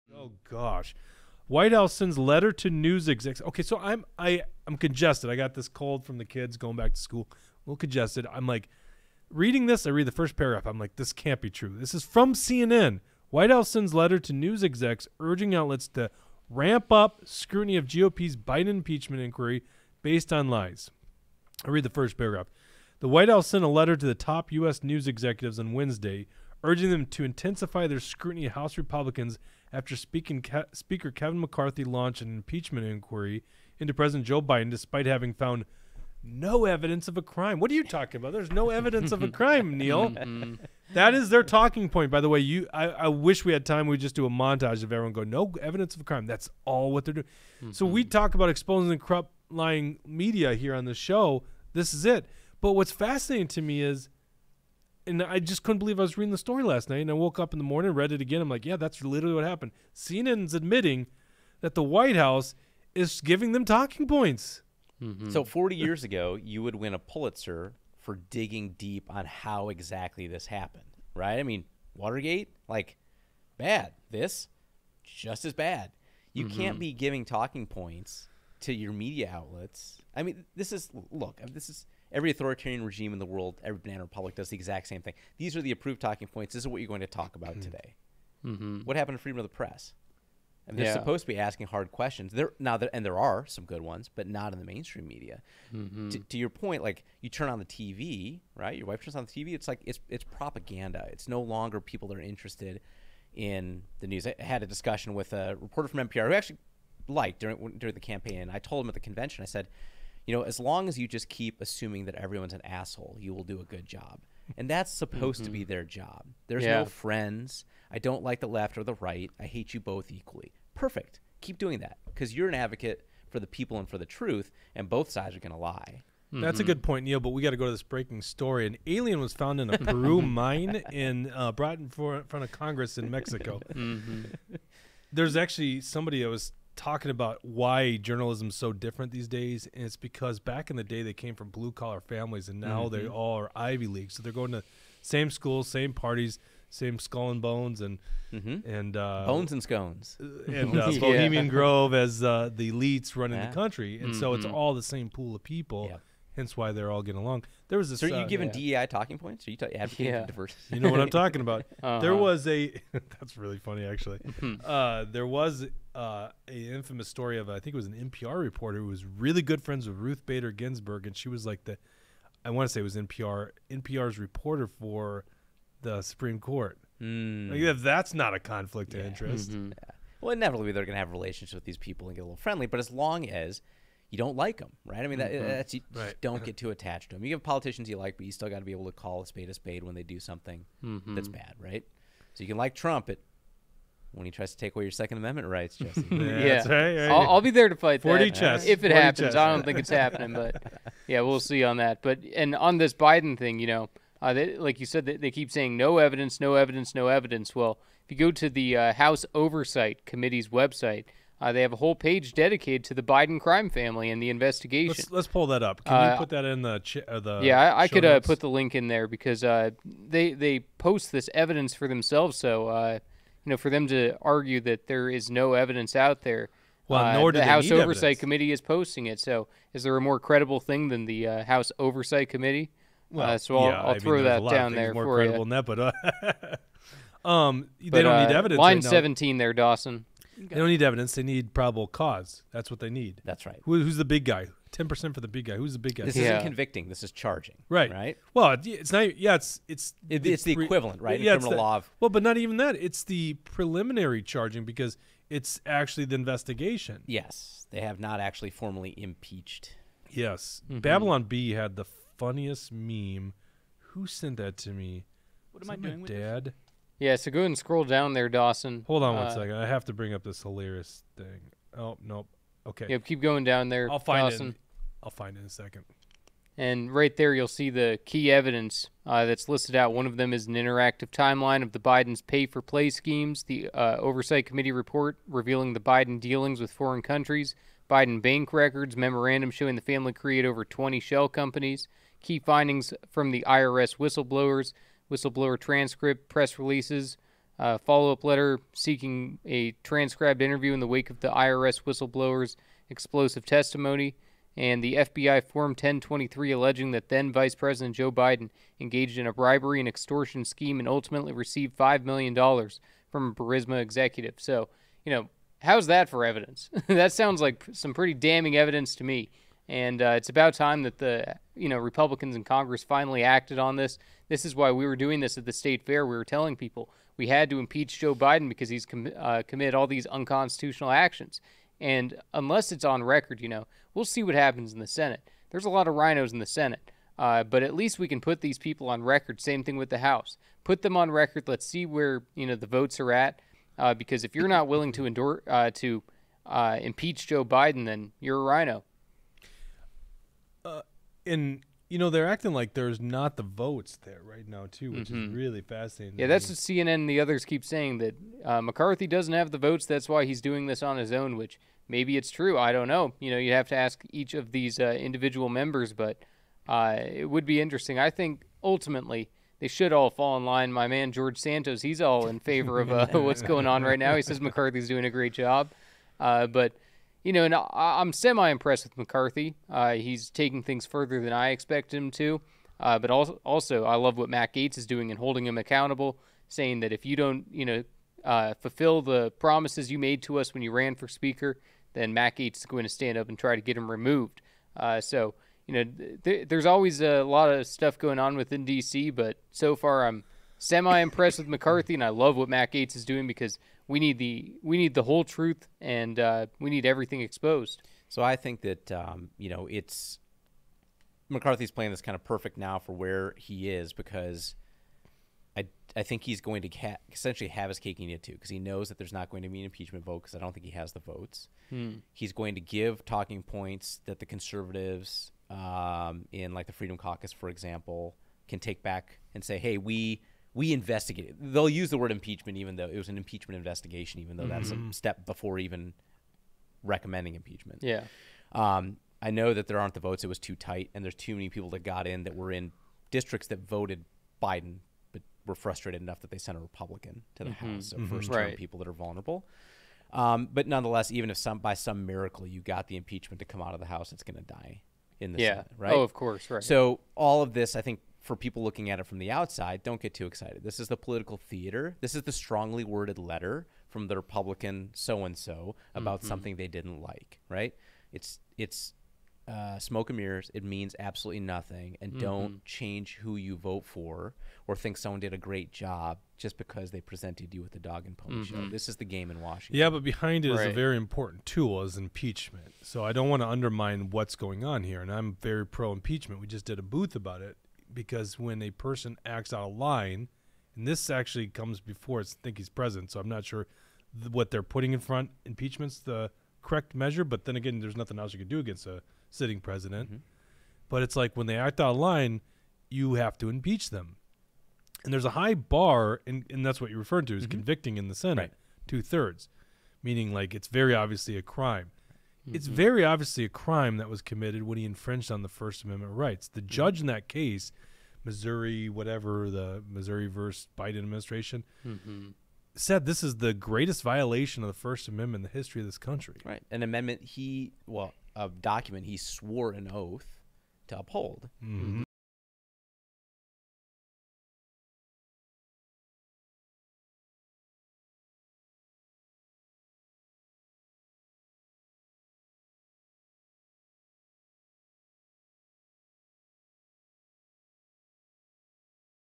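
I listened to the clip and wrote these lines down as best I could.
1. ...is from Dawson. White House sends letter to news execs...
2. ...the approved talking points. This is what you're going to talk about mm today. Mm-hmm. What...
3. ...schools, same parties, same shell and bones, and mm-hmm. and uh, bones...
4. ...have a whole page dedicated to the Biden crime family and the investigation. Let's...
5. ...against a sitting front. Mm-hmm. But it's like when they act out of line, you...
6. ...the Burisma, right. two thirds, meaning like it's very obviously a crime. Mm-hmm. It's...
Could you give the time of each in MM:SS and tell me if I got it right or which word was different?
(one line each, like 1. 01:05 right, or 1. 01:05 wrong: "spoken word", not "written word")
1. 00:11 wrong: "CNN", not "Dawson"
2. 01:25 right
3. 02:25 wrong: "skull", not "shell"
4. 03:31 right
5. 08:18 wrong: "president", not "front"
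6. 08:28 wrong: "Senate", not "Burisma".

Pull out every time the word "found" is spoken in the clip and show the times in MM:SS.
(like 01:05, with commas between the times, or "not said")
00:35, 02:09.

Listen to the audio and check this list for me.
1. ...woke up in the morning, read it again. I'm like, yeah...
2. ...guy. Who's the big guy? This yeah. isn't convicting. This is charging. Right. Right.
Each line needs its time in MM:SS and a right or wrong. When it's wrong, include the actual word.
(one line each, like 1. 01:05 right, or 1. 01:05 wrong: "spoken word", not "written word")
1. 00:57 right
2. 04:05 right.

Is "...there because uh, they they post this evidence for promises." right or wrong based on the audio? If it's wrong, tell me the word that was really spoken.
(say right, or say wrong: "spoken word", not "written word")
wrong: "themselves", not "promises".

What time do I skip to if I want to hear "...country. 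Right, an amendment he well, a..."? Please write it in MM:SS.
08:45.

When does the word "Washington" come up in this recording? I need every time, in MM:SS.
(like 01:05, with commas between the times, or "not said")
07:59.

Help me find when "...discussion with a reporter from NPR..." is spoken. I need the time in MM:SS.
01:44.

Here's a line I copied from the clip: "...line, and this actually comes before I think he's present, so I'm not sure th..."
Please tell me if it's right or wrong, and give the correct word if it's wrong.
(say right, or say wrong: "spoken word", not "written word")
right.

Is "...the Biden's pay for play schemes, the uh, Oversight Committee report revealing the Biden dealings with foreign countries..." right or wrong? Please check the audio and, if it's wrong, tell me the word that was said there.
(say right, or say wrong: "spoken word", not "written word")
right.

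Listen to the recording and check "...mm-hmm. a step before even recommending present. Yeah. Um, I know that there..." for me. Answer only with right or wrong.
wrong.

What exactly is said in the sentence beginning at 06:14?
He says McCarthy's doing a great job, uh, but you know, and I, am semi impressed with McCarthy.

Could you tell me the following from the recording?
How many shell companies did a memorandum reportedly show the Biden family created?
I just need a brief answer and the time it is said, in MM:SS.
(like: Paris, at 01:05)
over 20, at 04:50.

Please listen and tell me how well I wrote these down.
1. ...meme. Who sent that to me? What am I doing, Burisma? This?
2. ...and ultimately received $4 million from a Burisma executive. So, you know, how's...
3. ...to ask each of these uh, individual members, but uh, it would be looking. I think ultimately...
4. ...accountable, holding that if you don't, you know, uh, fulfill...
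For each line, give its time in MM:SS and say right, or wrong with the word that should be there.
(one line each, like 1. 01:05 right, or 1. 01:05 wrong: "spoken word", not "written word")
1. 04:22 wrong: "Dad", not "Burisma"
2. 05:10 wrong: "5", not "4"
3. 06:03 wrong: "interesting", not "looking"
4. 06:25 wrong: "saying", not "holding".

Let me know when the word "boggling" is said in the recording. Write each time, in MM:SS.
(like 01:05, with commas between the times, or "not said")
not said.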